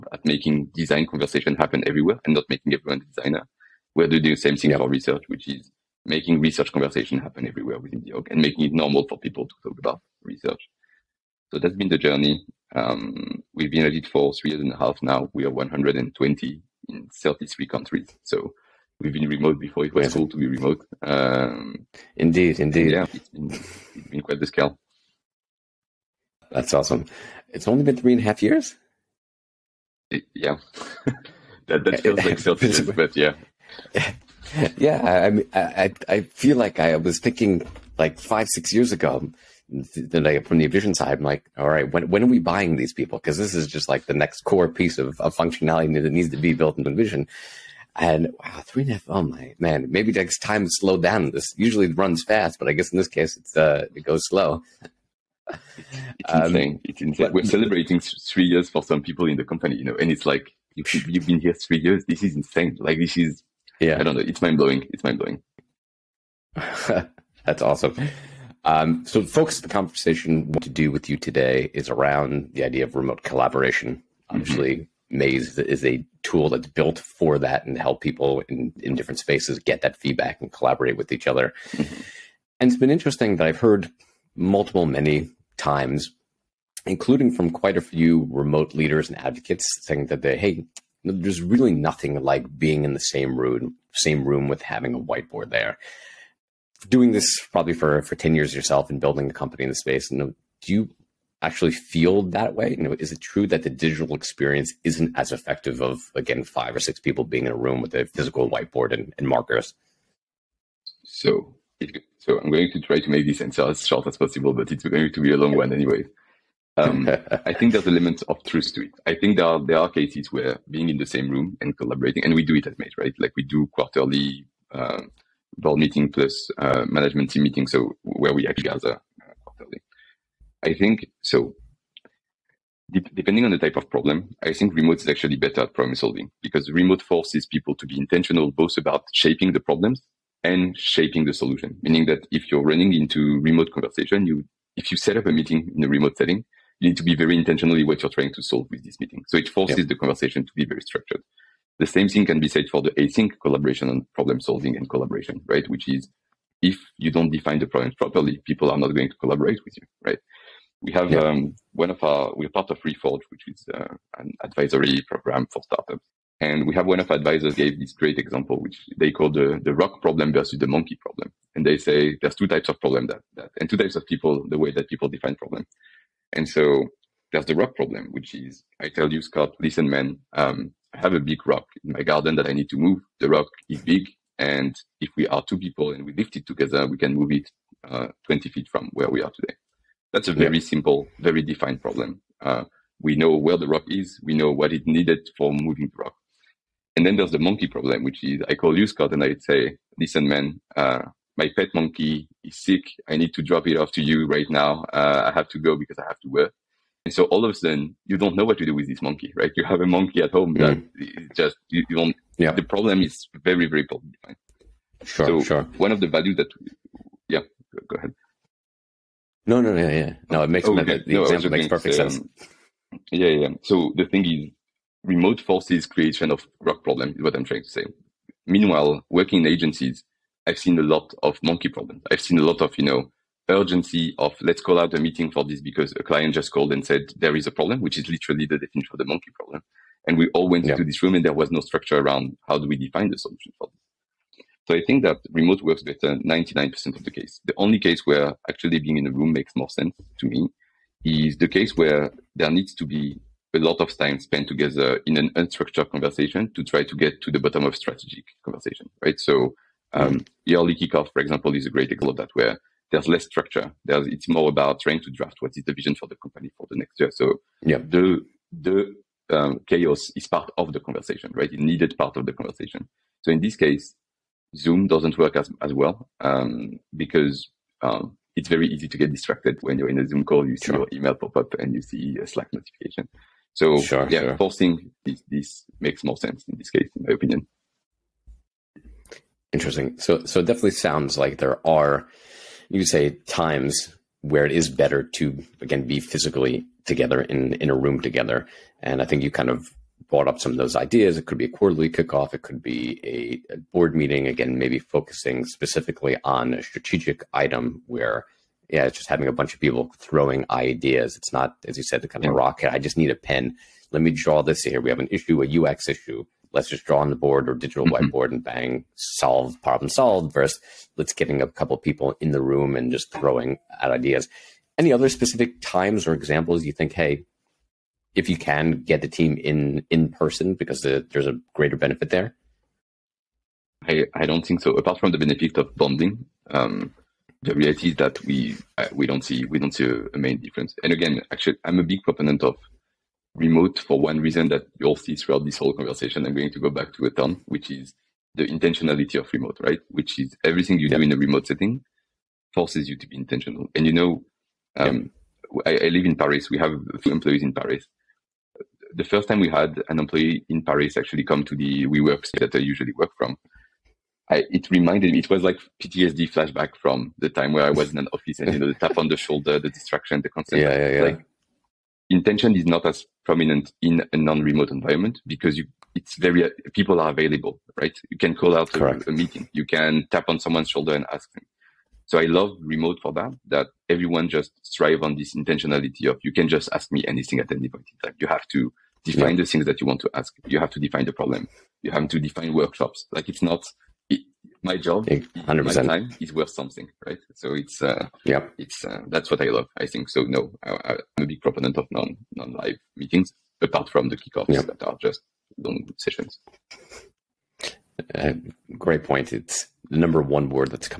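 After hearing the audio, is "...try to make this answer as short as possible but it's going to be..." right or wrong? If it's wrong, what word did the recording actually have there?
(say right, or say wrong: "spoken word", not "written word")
right.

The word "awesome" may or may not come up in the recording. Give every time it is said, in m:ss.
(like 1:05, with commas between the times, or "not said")
0:26, 1:07.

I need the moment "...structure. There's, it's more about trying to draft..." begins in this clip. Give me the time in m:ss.
4:23.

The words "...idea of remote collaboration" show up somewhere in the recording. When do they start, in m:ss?
1:12.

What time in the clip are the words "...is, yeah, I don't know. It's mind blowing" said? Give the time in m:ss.
1:03.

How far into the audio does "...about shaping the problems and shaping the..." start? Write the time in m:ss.
2:18.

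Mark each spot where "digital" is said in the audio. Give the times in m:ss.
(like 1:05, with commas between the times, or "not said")
1:43, 5:17.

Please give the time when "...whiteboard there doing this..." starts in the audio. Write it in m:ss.
1:35.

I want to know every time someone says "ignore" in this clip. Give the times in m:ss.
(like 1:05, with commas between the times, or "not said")
not said.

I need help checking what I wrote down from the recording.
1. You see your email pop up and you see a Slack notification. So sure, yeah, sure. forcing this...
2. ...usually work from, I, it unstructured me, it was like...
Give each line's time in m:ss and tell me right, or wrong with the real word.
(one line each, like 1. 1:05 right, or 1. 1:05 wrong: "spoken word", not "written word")
1. 4:40 right
2. 6:02 wrong: "reminded", not "unstructured".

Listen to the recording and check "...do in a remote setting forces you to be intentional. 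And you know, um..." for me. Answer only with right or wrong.
right.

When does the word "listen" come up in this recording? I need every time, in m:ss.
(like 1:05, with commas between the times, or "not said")
2:59, 3:19.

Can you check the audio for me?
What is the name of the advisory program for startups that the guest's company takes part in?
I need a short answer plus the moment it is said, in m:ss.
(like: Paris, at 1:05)
Reforge, at 2:42.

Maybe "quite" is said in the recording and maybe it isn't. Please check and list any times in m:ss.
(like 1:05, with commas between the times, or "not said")
0:24, 1:27.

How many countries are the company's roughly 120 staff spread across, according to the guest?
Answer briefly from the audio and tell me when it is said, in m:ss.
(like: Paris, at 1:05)
33, at 0:17.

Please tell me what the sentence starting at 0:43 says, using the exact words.
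Because this is just like the next core piece of, of functionality that needs to be built into InVision.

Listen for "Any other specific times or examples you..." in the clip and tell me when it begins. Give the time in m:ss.
5:24.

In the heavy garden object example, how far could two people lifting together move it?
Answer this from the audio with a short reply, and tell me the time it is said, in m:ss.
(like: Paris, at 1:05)
20 feet, at 3:08.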